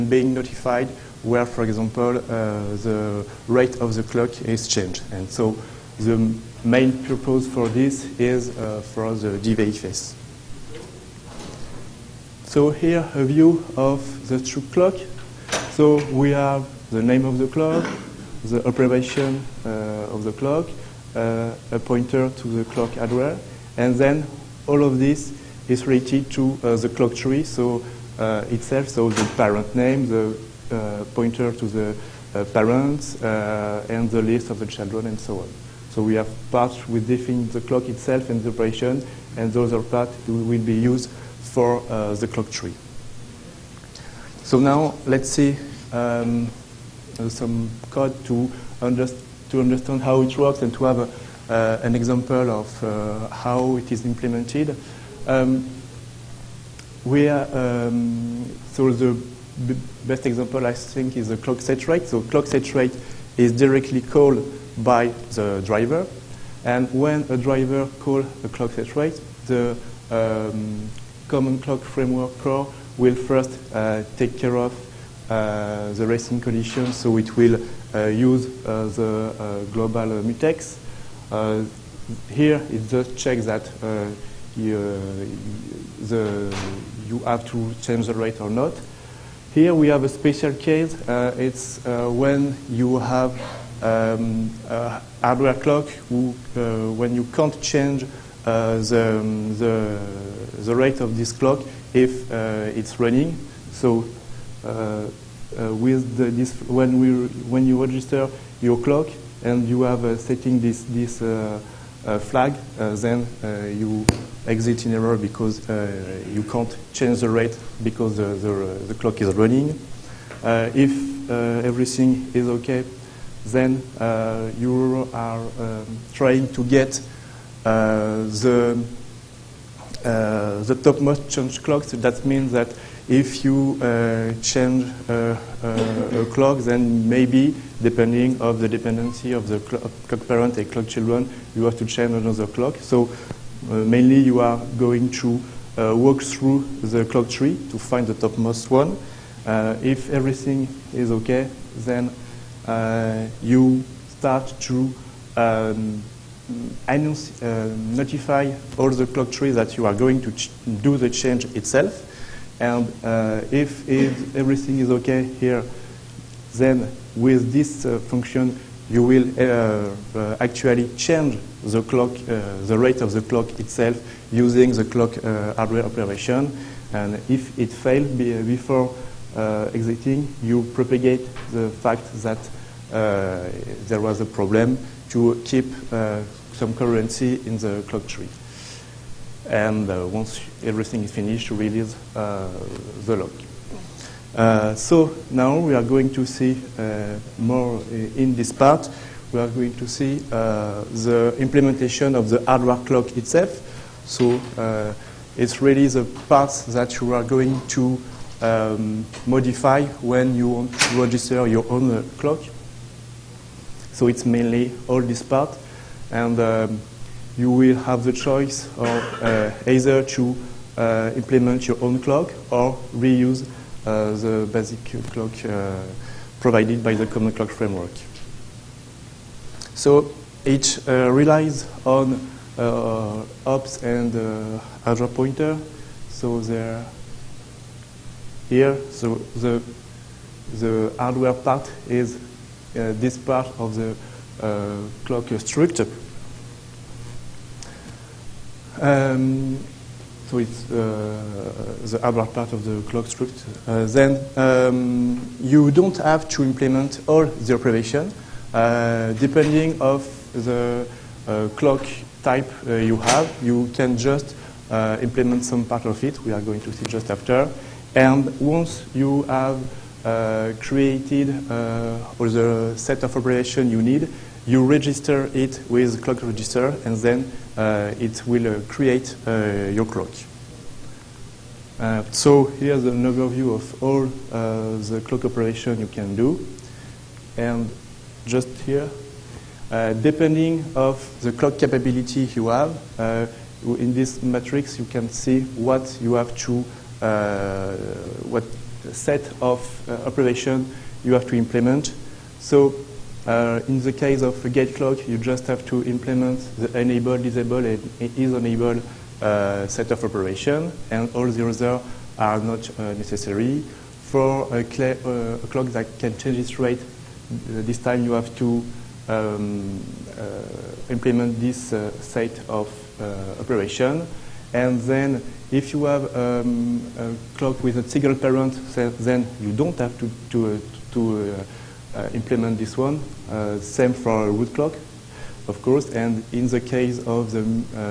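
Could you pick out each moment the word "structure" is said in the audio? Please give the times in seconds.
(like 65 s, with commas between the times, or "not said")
245 s.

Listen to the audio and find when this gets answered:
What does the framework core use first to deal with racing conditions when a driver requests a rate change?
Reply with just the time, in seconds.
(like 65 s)
79 s.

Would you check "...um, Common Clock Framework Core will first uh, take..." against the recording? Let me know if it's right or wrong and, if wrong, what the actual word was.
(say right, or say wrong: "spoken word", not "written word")
right.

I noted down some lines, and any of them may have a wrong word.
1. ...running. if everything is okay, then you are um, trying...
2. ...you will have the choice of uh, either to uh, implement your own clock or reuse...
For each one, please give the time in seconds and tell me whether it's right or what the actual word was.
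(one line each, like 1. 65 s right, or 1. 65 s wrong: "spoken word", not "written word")
1. 119 s right
2. 217 s right.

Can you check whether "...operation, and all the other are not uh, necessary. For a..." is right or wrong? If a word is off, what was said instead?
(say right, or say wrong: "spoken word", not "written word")
right.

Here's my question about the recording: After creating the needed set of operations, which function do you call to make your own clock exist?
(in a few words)
clock register.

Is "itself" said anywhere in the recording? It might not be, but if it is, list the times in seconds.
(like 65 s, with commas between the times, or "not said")
28 s, 37 s, 161 s, 173 s, 203 s.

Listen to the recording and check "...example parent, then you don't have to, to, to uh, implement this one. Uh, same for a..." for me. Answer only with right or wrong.
wrong.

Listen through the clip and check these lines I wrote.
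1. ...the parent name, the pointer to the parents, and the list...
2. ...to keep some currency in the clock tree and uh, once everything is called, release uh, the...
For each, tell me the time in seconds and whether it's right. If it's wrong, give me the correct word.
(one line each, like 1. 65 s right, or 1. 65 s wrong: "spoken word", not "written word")
1. 29 s right
2. 185 s wrong: "finished", not "called".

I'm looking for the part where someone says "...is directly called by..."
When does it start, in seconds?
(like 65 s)
63 s.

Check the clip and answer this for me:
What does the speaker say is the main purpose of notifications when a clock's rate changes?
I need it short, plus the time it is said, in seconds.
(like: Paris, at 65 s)
DVFS, at 9 s.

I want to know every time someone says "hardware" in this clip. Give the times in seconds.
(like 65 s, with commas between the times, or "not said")
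22 s, 95 s, 175 s, 202 s, 240 s.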